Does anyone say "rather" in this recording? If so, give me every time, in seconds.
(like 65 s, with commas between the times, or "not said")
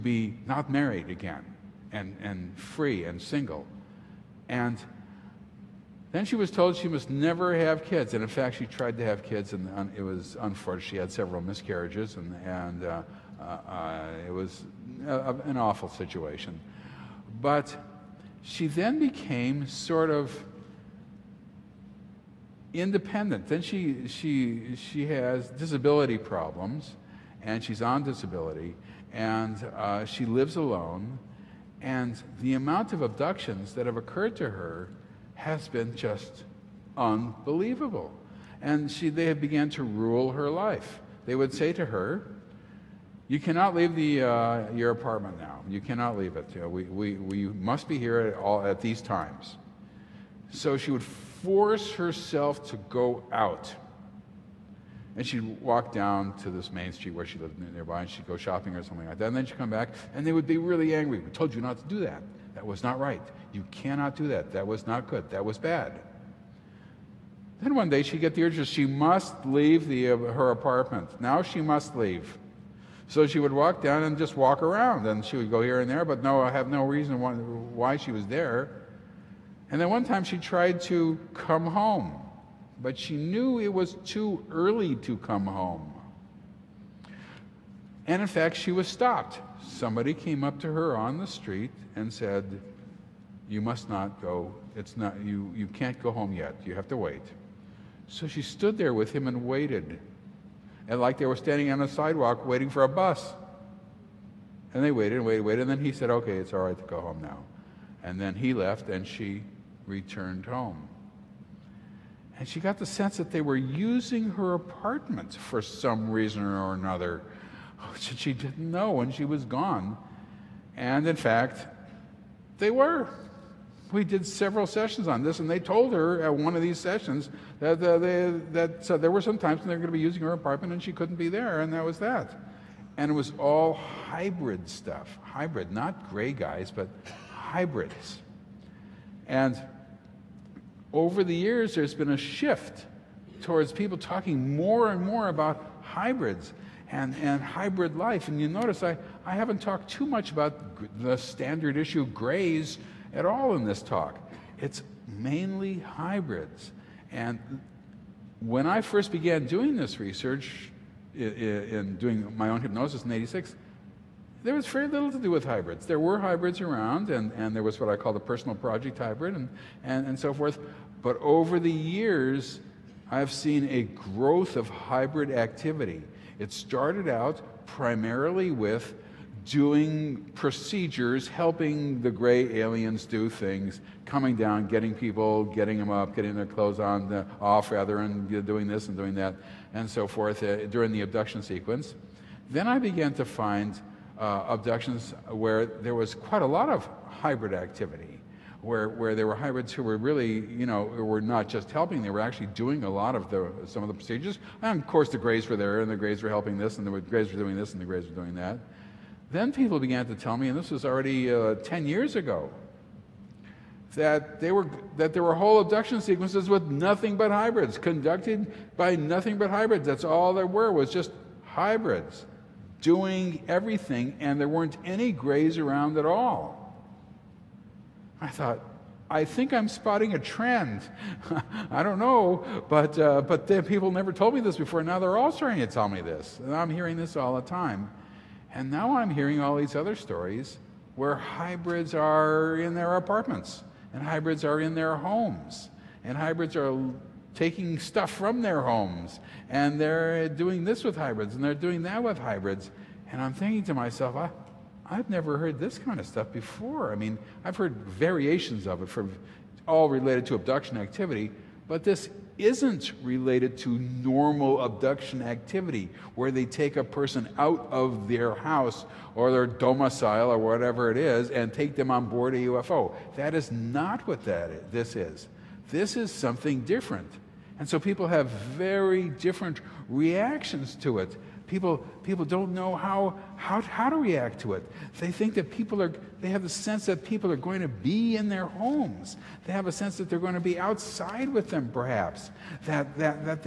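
187 s.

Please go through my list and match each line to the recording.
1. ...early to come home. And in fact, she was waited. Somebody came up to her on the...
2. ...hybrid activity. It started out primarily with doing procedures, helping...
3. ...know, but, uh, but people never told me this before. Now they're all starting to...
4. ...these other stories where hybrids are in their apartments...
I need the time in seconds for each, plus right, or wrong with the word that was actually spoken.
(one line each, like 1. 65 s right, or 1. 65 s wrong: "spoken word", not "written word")
1. 84 s wrong: "stopped", not "waited"
2. 174 s right
3. 231 s right
4. 239 s right.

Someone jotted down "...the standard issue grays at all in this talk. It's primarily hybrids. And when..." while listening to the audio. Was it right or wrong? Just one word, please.
wrong.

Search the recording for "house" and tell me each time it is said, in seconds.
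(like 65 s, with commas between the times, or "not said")
268 s.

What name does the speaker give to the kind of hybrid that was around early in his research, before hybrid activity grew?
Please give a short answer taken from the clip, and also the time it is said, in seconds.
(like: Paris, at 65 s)
Personal project hybrid, at 168 s.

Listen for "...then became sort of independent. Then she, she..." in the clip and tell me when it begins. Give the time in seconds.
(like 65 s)
18 s.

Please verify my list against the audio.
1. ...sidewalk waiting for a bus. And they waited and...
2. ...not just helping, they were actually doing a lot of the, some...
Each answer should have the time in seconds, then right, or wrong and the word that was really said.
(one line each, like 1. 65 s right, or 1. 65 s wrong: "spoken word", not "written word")
1. 101 s right
2. 201 s right.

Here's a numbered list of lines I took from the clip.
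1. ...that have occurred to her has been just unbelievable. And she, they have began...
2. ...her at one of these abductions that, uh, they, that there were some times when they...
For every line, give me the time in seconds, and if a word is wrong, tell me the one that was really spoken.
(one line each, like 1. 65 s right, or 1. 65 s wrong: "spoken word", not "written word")
1. 33 s right
2. 125 s wrong: "sessions", not "abductions".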